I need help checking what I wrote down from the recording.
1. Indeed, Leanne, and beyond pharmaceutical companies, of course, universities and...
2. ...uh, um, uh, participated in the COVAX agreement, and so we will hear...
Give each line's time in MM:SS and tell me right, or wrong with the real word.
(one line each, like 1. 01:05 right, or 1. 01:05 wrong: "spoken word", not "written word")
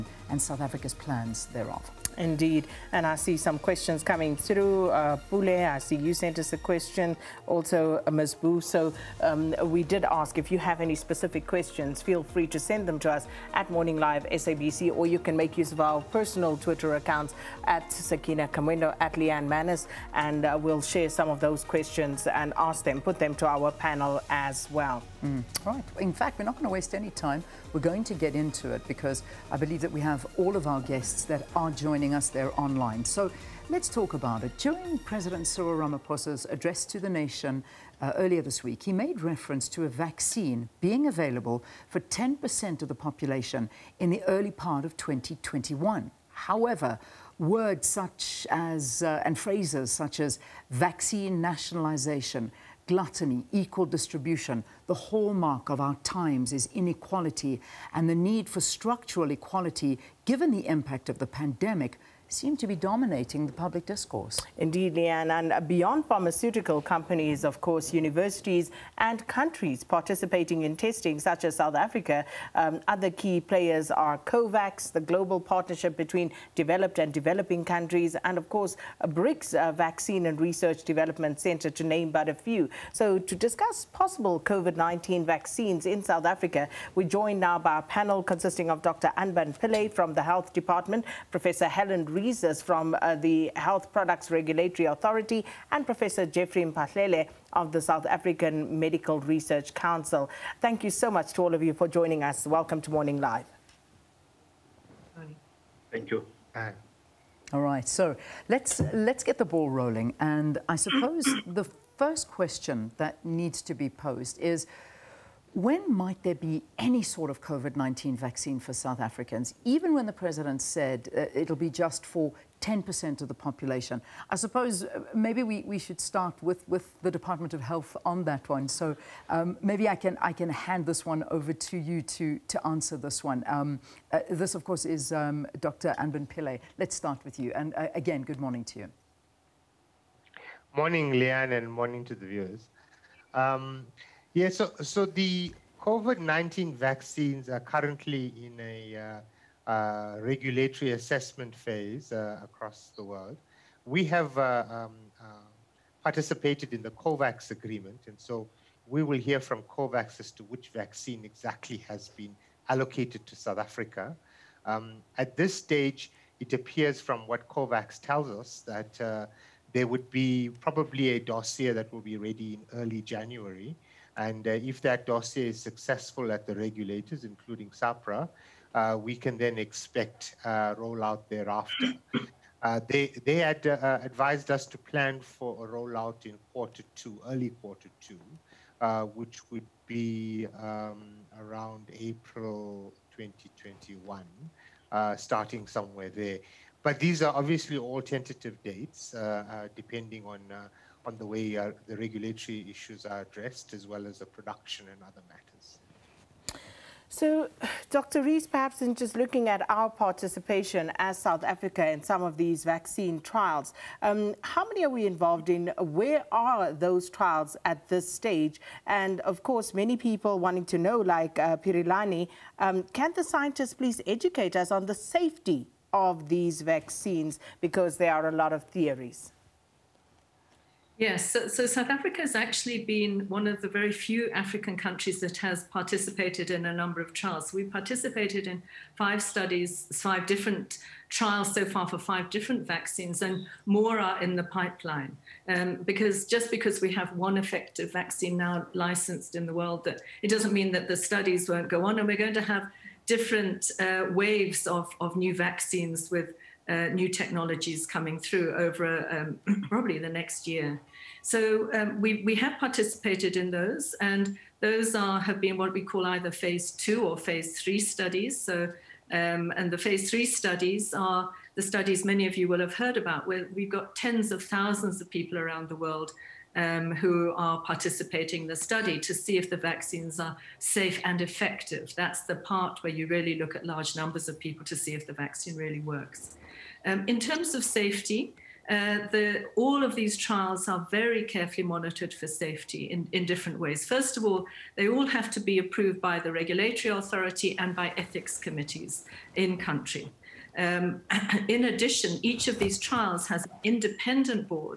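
1. 01:04 right
2. 02:34 right.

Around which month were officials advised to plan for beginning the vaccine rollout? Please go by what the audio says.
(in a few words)
April 2021.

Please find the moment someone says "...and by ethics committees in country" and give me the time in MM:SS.
04:57.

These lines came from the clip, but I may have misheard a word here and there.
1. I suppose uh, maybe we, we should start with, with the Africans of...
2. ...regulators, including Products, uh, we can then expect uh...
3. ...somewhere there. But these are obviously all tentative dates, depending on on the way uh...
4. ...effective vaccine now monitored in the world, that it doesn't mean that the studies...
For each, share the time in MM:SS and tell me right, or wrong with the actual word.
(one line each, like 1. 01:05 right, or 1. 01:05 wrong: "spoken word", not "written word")
1. 02:04 wrong: "Department", not "Africans"
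2. 02:56 wrong: "SAHPRA", not "Products"
3. 03:15 right
4. 04:07 wrong: "licensed", not "monitored".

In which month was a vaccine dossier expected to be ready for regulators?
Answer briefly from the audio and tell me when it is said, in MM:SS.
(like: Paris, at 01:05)
January, at 02:52.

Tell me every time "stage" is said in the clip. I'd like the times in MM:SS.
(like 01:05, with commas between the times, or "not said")
02:45, 03:38.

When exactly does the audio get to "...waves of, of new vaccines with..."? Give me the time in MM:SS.
04:14.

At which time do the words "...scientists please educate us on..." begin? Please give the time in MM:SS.
03:43.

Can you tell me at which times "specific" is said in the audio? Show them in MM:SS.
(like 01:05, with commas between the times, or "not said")
00:10.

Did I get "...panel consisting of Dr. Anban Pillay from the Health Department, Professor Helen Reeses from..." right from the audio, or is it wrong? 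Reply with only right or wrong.
right.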